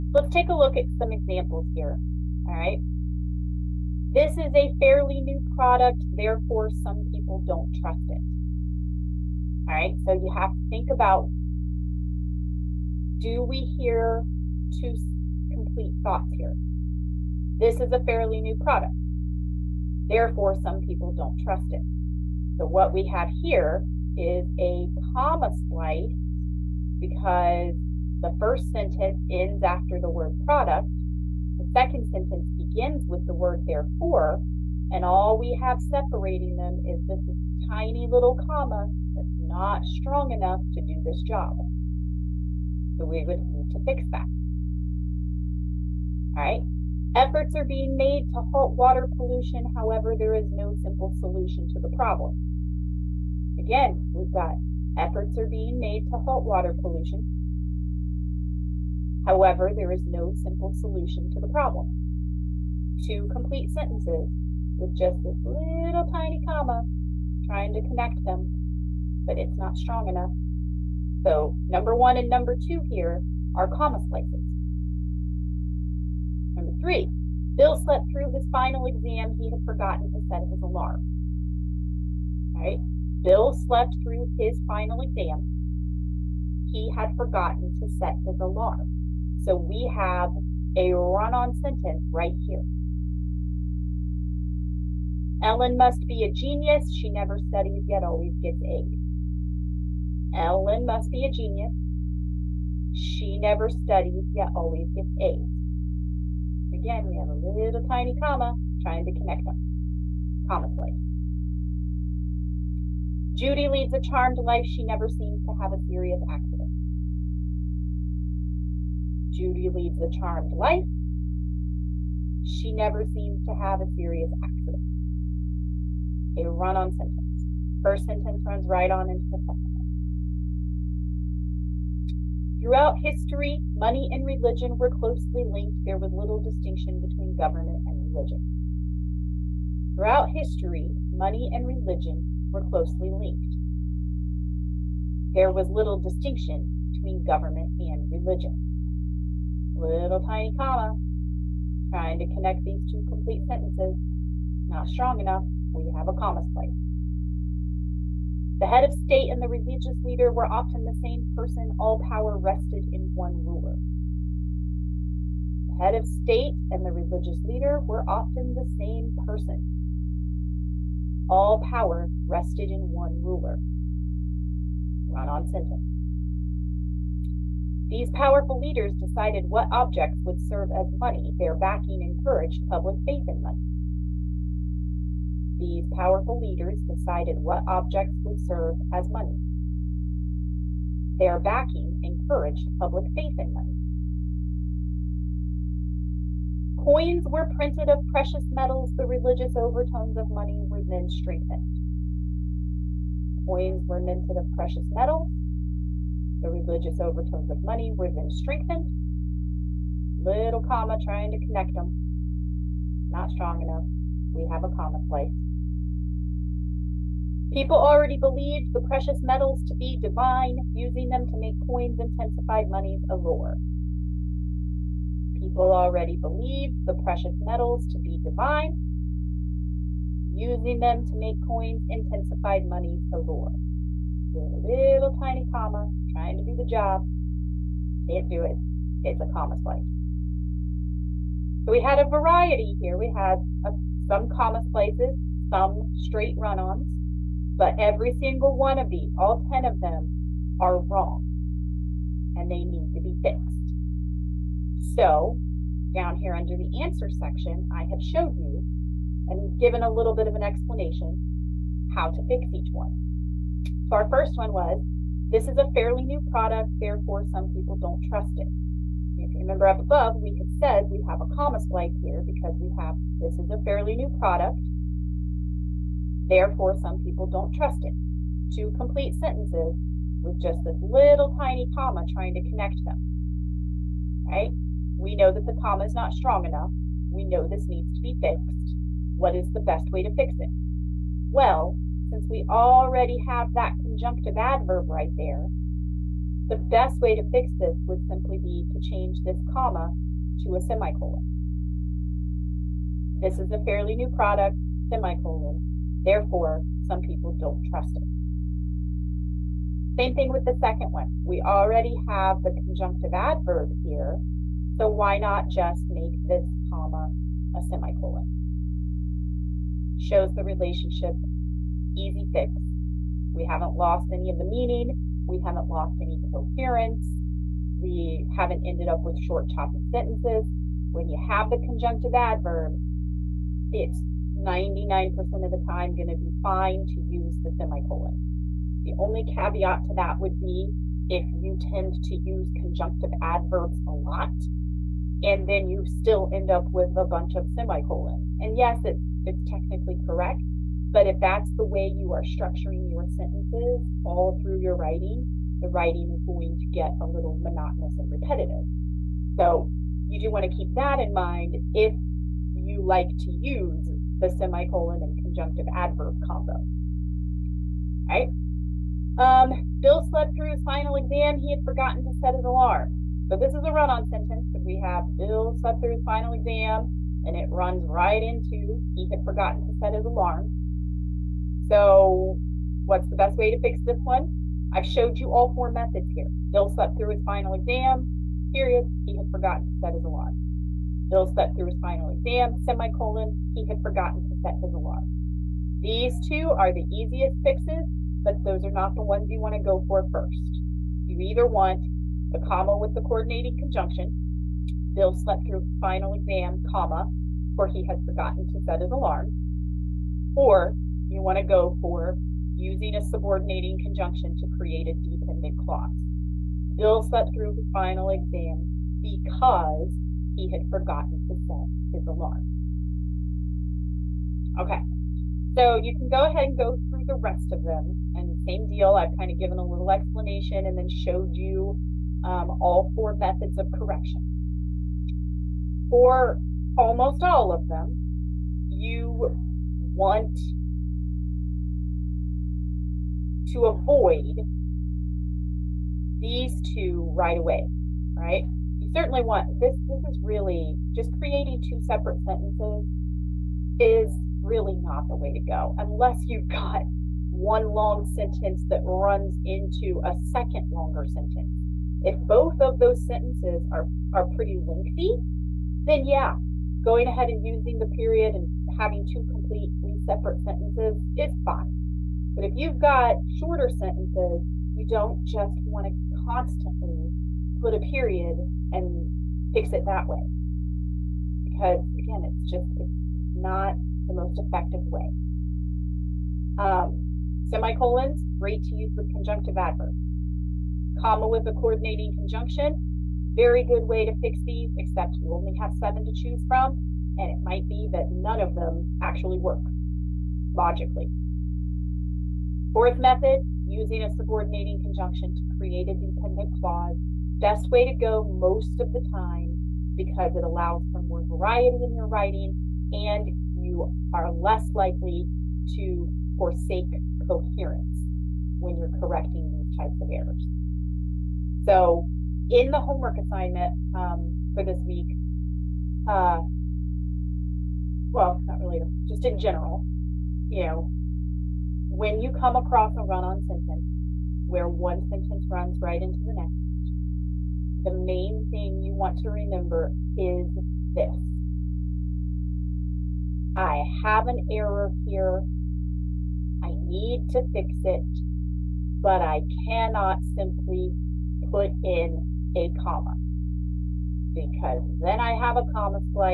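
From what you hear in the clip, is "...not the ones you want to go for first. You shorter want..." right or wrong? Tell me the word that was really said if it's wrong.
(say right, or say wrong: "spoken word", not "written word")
wrong: "either", not "shorter".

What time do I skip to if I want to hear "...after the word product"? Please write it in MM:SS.
00:29.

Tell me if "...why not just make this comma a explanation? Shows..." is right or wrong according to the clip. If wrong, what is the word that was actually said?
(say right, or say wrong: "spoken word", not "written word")
wrong: "semicolon", not "explanation".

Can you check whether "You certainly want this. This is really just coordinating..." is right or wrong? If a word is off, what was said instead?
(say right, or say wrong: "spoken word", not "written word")
wrong: "creating", not "coordinating".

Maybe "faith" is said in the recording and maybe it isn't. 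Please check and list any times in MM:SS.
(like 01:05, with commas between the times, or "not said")
03:03, 03:13.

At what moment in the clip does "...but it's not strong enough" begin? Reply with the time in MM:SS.
01:09.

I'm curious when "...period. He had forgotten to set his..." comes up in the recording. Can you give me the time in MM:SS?
06:28.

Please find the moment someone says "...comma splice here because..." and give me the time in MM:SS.
04:31.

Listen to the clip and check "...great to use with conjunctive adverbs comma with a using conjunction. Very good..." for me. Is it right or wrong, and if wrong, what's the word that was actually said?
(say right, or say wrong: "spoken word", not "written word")
wrong: "coordinating", not "using".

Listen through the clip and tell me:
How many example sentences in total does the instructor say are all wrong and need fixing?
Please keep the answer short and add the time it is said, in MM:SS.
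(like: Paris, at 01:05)
10, at 04:09.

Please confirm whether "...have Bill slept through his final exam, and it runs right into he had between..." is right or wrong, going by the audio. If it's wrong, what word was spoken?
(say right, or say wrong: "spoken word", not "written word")
wrong: "forgotten", not "between".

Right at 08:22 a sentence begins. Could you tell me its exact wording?
Fourth method, using a subordinating conjunction to create a dependent clause.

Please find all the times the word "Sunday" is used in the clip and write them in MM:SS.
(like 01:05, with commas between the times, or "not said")
not said.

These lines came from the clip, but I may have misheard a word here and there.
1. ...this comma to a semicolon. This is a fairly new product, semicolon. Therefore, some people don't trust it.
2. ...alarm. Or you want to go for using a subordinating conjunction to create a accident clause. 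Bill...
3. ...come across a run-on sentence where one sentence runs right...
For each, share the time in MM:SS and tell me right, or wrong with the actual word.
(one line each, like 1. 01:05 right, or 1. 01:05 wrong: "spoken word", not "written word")
1. 04:59 right
2. 06:48 wrong: "dependent", not "accident"
3. 08:52 right.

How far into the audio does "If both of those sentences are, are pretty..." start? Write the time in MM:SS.
07:42.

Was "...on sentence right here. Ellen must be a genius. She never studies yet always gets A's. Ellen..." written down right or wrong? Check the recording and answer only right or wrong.
right.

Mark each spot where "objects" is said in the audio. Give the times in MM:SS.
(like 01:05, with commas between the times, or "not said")
02:59, 03:07.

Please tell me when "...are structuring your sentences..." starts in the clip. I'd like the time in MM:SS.
05:52.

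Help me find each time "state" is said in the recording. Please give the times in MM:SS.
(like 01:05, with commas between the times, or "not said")
02:39, 02:46.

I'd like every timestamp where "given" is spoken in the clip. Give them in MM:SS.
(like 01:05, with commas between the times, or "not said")
04:19, 07:09.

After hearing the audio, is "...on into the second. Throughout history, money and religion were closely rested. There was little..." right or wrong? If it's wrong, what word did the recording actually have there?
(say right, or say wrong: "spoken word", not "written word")
wrong: "linked", not "rested".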